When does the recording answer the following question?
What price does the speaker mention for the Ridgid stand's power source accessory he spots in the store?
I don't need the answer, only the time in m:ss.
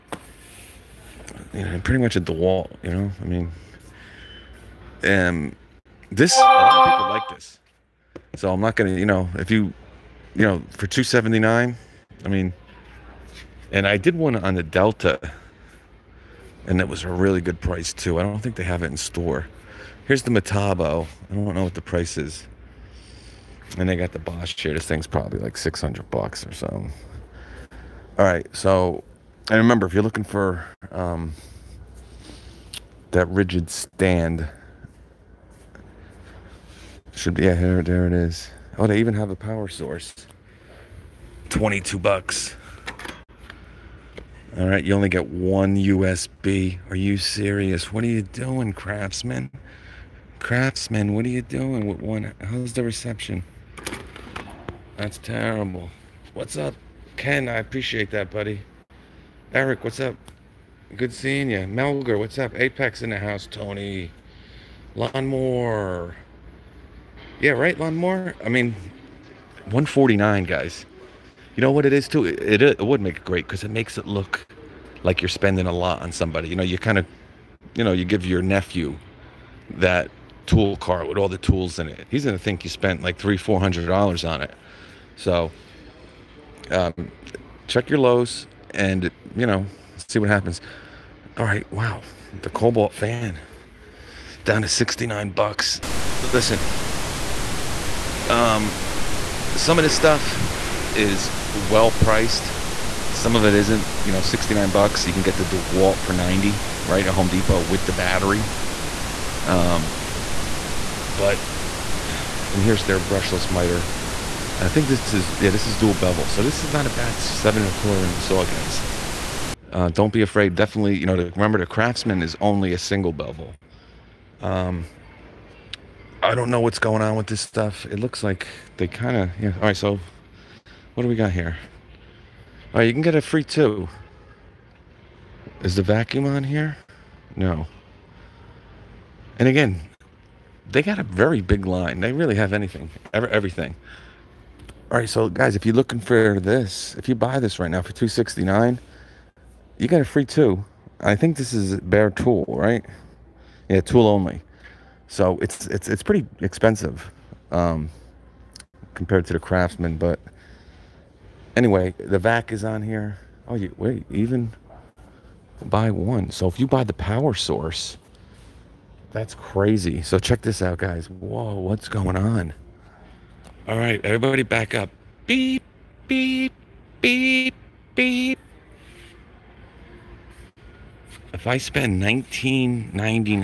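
0:41.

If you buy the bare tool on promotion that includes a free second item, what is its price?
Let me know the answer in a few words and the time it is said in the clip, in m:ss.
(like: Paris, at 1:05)
$269, at 2:27.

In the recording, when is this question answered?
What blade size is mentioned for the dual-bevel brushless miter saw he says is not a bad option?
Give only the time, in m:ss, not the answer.
1:57.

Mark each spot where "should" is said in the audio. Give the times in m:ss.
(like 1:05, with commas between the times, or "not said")
0:37.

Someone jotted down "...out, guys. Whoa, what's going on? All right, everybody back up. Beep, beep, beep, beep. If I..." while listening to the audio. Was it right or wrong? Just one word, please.
right.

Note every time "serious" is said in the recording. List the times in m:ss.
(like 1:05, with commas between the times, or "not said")
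0:47.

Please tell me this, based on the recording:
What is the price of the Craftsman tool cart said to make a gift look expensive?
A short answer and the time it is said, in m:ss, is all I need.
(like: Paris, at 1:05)
$149, at 1:09.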